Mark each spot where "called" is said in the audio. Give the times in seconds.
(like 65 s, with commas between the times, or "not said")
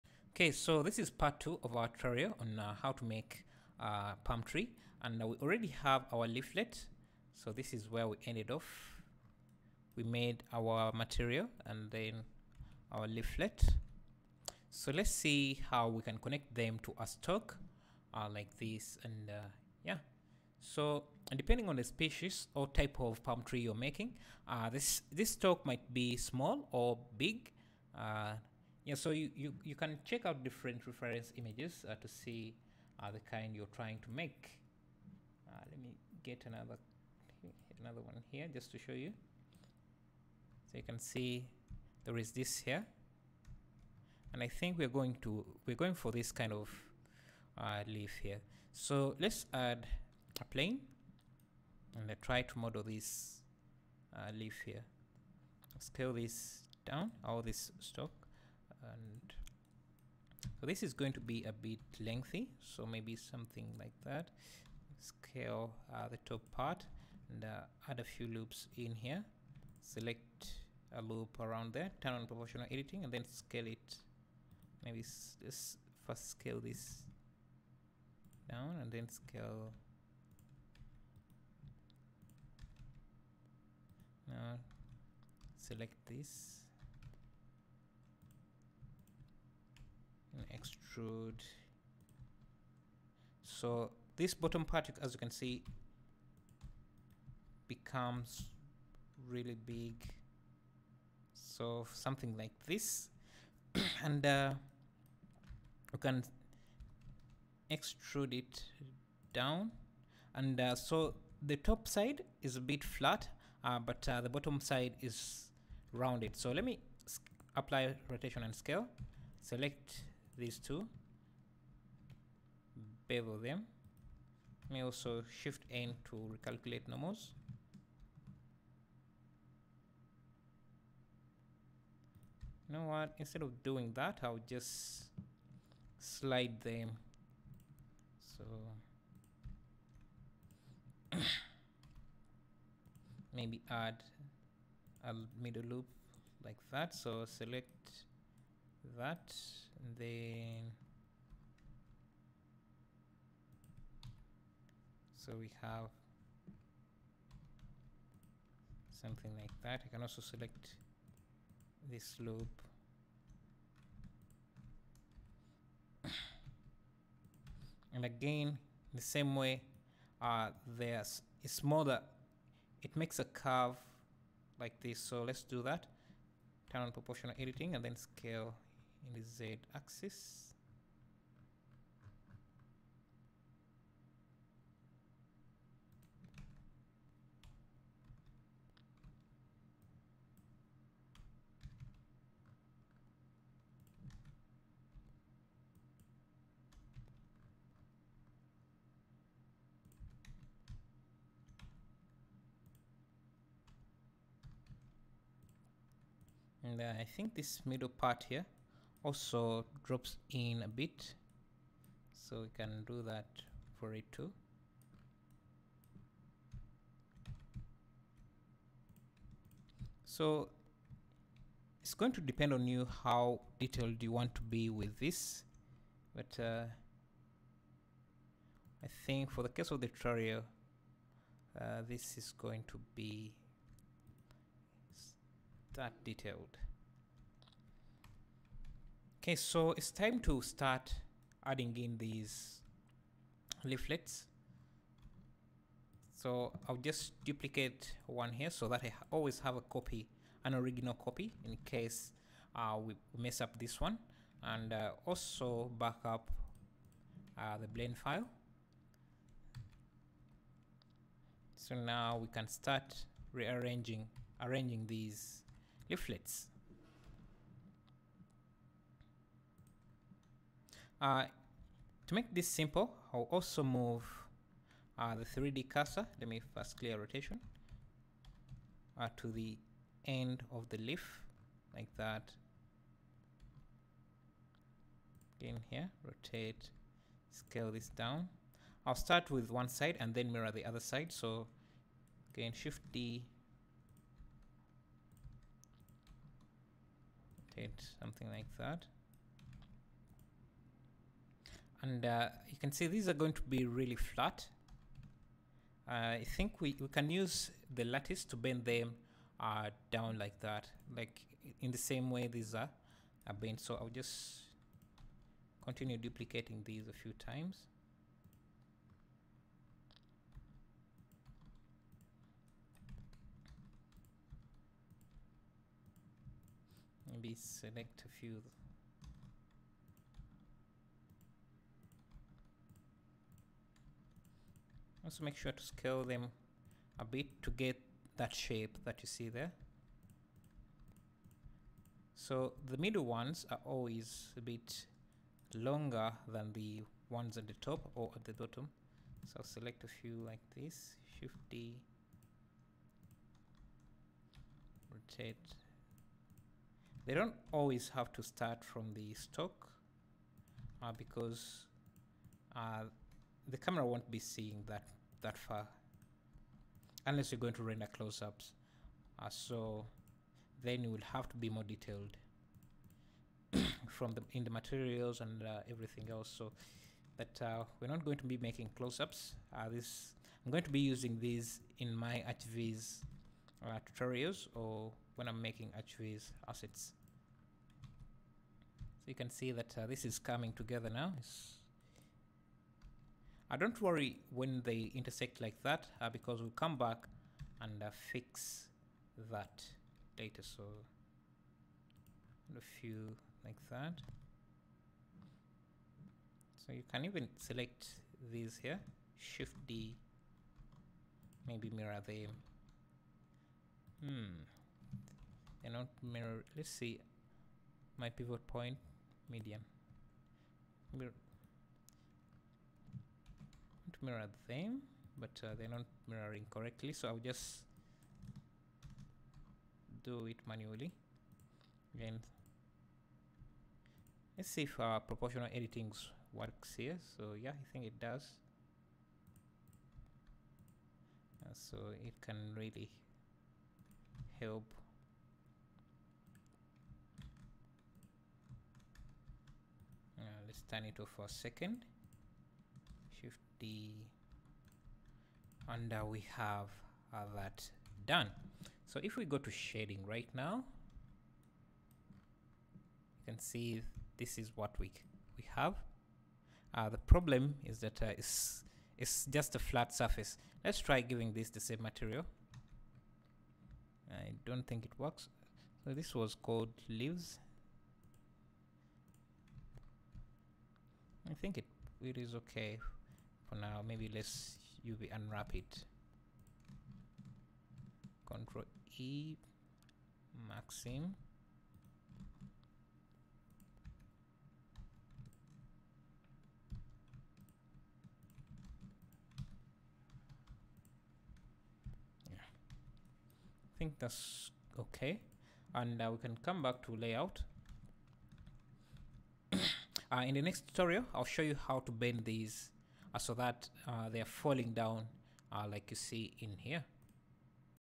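476 s.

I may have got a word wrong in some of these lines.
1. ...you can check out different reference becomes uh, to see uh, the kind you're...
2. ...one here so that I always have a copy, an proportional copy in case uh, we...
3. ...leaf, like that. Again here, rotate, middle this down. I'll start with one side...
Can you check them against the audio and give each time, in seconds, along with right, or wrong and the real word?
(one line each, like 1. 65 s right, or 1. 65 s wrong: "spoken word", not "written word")
1. 29 s wrong: "images", not "becomes"
2. 248 s wrong: "original", not "proportional"
3. 280 s wrong: "scale", not "middle".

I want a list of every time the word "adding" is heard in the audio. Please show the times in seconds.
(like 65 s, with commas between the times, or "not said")
241 s.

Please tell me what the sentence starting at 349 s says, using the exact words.
So I'll select a few like this, Shift D, rotate.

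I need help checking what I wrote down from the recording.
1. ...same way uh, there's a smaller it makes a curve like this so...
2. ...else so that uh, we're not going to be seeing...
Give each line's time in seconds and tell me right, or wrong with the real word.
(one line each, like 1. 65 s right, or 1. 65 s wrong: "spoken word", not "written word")
1. 169 s right
2. 376 s wrong: "making", not "seeing".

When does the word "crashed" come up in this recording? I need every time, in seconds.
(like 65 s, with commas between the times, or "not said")
not said.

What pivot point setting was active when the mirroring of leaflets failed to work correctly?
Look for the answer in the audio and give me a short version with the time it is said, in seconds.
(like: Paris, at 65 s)
Median, at 419 s.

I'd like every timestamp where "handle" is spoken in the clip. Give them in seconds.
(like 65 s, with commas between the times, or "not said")
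not said.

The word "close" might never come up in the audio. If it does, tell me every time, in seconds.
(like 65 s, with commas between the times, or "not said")
367 s, 378 s.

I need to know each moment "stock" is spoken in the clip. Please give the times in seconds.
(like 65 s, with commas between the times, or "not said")
17 s, 25 s, 359 s.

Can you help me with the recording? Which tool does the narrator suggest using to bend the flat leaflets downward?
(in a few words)
Lattice.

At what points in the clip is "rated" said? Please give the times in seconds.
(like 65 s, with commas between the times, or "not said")
not said.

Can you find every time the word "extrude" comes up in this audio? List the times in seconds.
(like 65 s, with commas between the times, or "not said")
90 s, 107 s.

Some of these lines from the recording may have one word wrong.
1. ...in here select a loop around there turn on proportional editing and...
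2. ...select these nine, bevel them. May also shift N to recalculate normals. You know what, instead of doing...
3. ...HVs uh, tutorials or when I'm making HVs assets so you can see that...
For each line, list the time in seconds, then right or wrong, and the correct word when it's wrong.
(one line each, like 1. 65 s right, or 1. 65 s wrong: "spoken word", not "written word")
1. 68 s right
2. 119 s wrong: "two", not "nine"
3. 382 s right.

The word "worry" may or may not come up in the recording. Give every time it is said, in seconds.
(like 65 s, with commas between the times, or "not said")
393 s.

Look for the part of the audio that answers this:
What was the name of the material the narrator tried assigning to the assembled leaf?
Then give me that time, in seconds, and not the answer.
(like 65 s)
476 s.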